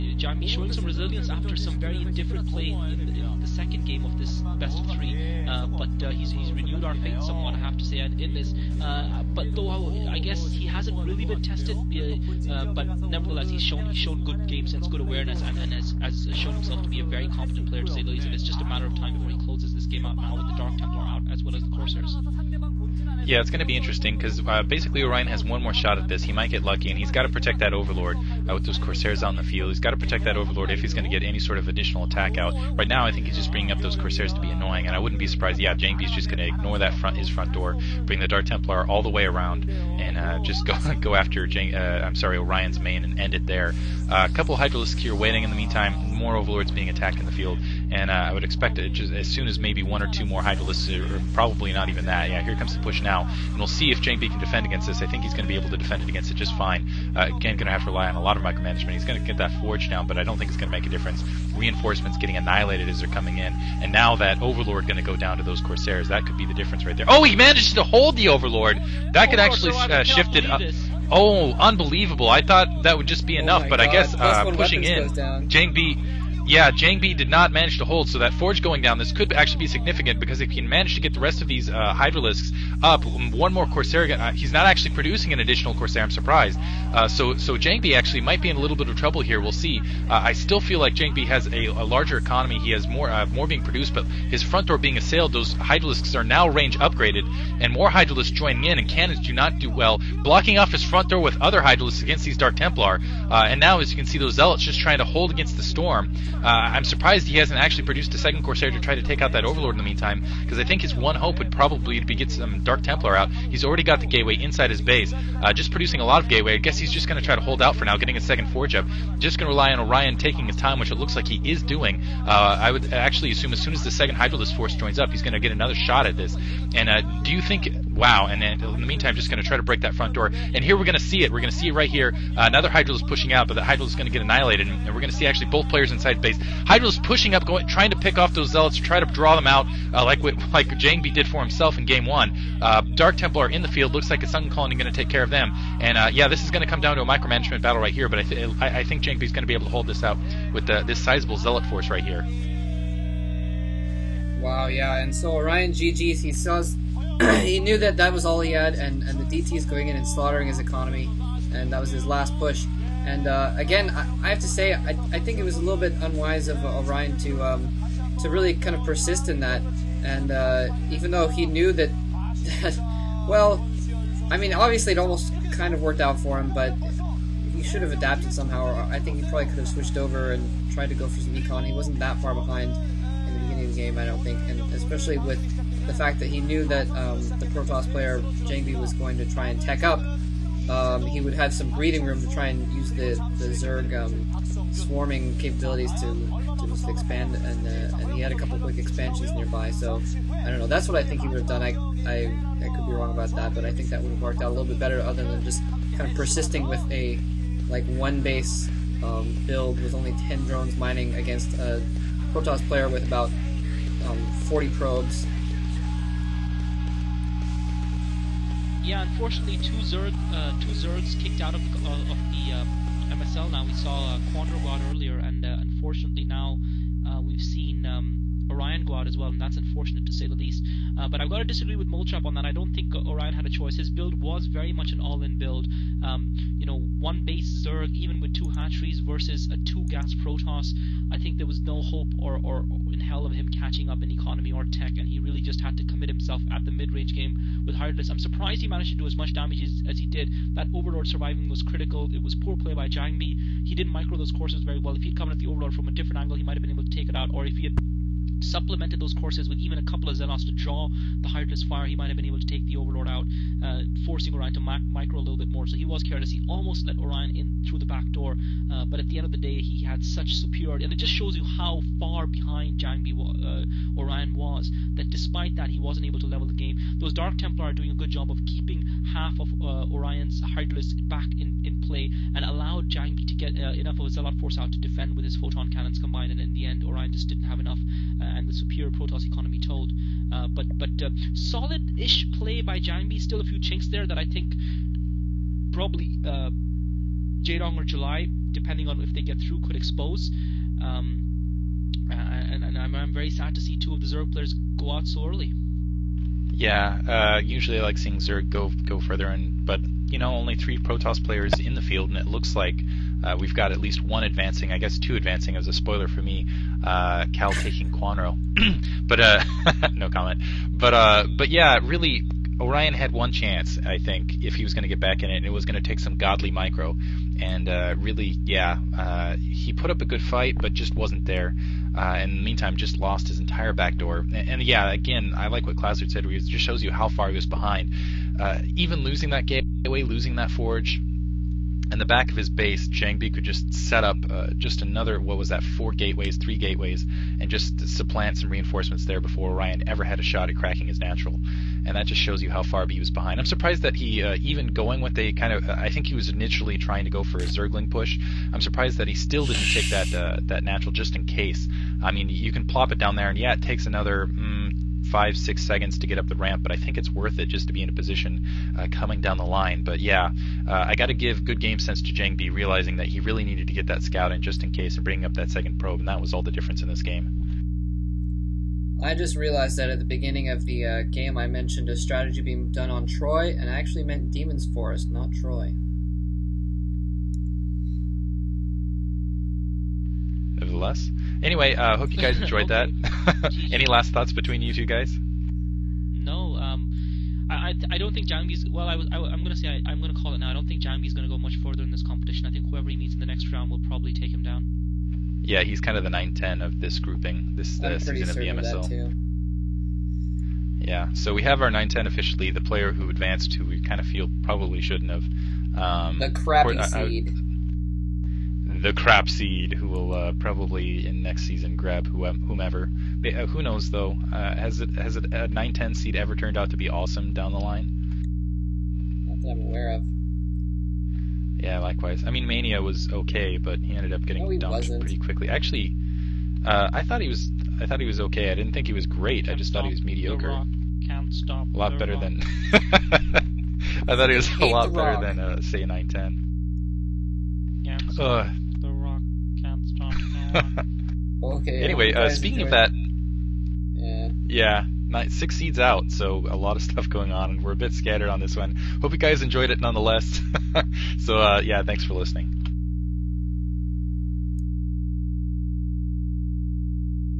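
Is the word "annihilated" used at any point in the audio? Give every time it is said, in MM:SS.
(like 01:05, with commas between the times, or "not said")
01:02, 02:14.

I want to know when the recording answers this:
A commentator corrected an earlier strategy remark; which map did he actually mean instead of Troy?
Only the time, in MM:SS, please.
06:24.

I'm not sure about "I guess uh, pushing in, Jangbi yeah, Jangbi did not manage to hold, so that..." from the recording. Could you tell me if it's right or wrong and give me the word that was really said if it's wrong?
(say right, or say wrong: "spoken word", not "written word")
right.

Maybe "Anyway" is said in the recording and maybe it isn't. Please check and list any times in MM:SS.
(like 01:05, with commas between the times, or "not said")
06:31, 07:31.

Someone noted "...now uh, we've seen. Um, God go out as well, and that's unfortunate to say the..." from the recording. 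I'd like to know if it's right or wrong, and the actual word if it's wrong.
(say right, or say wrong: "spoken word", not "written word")
wrong: "Orion", not "God".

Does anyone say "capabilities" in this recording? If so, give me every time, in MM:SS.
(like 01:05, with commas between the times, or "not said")
03:15.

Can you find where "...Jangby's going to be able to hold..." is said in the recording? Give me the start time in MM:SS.
02:29.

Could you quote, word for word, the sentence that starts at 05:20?
But uh, but yeah, really, Orion had one chance.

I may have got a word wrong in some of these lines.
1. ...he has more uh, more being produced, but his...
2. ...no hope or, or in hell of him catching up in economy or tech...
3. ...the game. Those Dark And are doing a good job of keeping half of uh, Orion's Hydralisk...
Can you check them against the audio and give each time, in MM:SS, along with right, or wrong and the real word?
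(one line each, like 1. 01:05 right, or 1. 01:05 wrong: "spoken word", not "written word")
1. 01:32 right
2. 04:01 right
3. 04:36 wrong: "Templar", not "And".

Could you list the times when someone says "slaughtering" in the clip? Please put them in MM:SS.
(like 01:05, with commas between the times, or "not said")
02:40.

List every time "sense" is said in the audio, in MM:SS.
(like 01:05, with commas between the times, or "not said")
00:14, 06:11.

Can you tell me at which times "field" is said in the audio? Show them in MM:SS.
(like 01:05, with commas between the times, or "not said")
00:29, 00:47, 02:23, 05:11.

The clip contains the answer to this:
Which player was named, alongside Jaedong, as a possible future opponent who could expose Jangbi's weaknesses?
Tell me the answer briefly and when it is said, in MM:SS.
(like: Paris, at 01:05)
July, at 04:57.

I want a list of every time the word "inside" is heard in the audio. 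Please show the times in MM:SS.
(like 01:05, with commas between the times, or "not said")
01:54, 02:15.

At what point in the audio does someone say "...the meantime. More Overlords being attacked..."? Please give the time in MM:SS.
00:45.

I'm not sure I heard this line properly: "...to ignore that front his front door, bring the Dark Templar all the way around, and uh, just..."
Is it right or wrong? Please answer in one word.
right.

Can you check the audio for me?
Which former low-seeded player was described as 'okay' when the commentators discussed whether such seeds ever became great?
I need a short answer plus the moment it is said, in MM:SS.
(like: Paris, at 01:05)
Mania, at 07:12.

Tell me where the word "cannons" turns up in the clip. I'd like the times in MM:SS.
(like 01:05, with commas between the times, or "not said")
01:38, 04:45.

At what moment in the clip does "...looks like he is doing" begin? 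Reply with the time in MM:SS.
02:00.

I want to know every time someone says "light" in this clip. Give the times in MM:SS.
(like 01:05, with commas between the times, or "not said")
not said.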